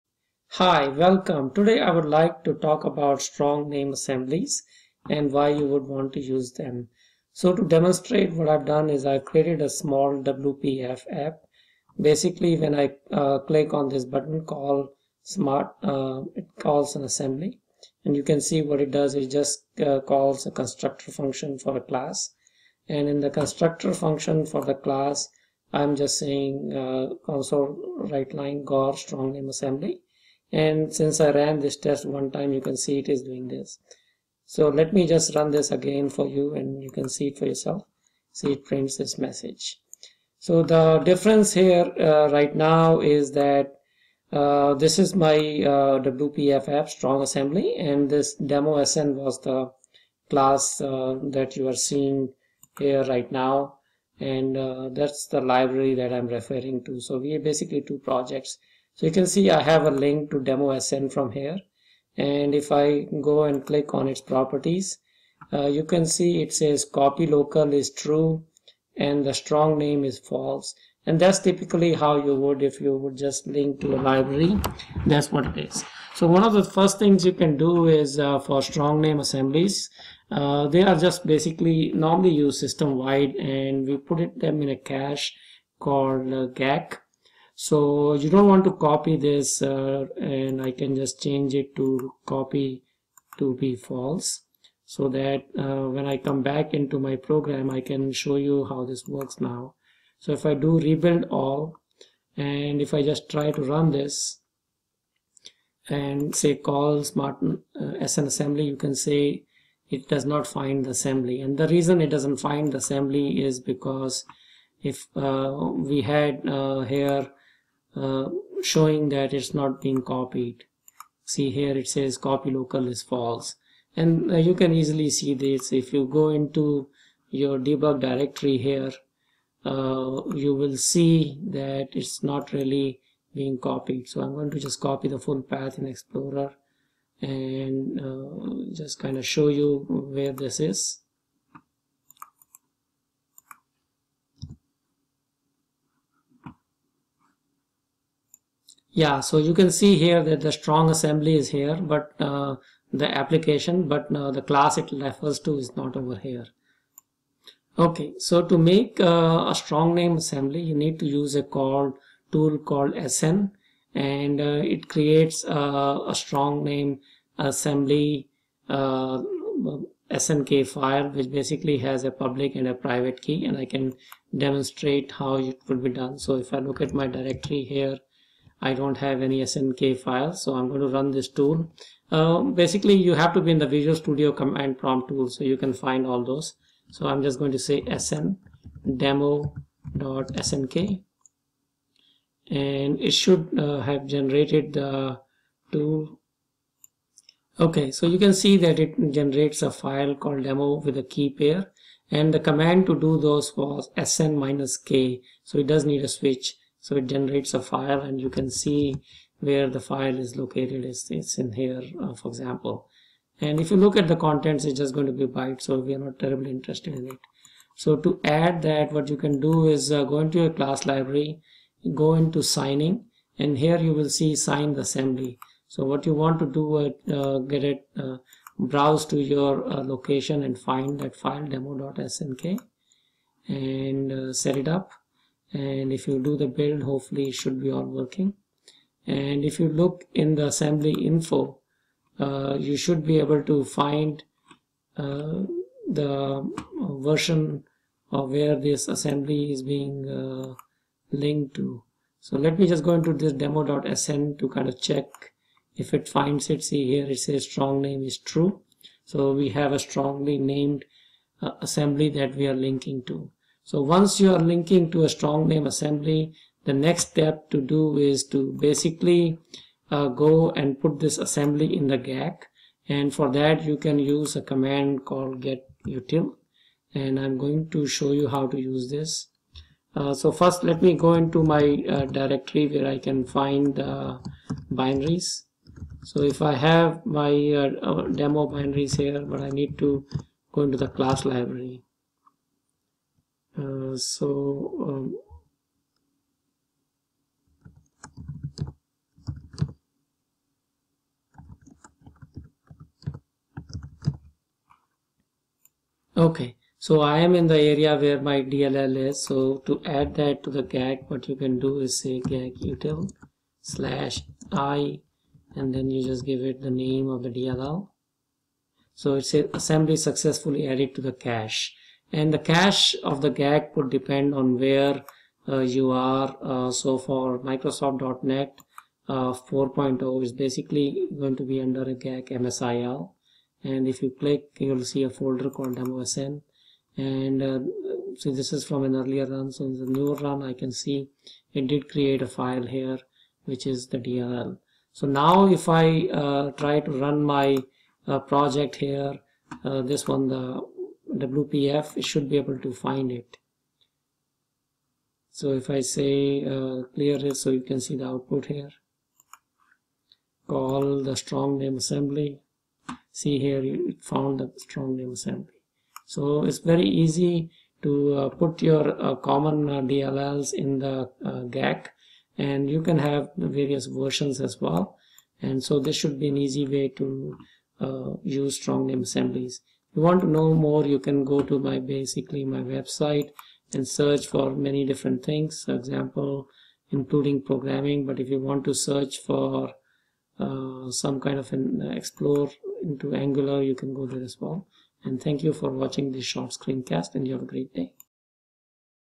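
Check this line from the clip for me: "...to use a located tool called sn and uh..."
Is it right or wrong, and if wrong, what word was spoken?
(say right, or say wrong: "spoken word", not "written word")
wrong: "called", not "located".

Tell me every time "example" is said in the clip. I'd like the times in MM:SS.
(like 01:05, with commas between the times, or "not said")
03:32, 06:25.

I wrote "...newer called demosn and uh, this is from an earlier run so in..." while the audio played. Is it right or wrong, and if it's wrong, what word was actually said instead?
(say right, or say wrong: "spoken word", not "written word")
wrong: "folder", not "newer".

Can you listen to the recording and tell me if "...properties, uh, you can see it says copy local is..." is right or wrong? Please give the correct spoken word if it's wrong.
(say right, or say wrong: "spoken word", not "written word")
right.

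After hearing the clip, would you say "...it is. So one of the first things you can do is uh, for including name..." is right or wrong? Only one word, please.
wrong.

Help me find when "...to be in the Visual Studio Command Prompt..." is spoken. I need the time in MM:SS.
03:03.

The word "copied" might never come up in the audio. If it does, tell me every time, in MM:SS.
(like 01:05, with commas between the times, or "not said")
02:00, 02:13.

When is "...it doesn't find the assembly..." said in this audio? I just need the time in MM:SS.
01:52.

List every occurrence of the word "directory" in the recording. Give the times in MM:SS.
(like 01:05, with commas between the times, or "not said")
02:07, 02:57, 04:42.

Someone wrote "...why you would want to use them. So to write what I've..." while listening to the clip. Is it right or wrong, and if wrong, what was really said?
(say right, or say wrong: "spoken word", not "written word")
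wrong: "demonstrate", not "write".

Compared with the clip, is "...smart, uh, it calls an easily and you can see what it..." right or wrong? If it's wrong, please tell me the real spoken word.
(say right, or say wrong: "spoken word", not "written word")
wrong: "assembly", not "easily".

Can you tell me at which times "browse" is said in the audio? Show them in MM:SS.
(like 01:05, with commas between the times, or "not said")
03:48.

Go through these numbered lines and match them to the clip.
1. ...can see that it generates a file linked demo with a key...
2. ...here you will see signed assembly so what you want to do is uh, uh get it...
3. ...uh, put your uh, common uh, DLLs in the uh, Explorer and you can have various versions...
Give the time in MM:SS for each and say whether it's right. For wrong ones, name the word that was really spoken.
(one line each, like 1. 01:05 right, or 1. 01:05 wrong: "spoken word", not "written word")
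1. 03:18 wrong: "called", not "linked"
2. 03:43 right
3. 06:08 wrong: "GAC", not "Explorer".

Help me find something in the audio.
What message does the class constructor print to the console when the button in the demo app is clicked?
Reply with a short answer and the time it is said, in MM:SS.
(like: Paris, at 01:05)
Gaur strong name assembly, at 00:28.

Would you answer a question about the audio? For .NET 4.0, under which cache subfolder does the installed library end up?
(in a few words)
GAC msil.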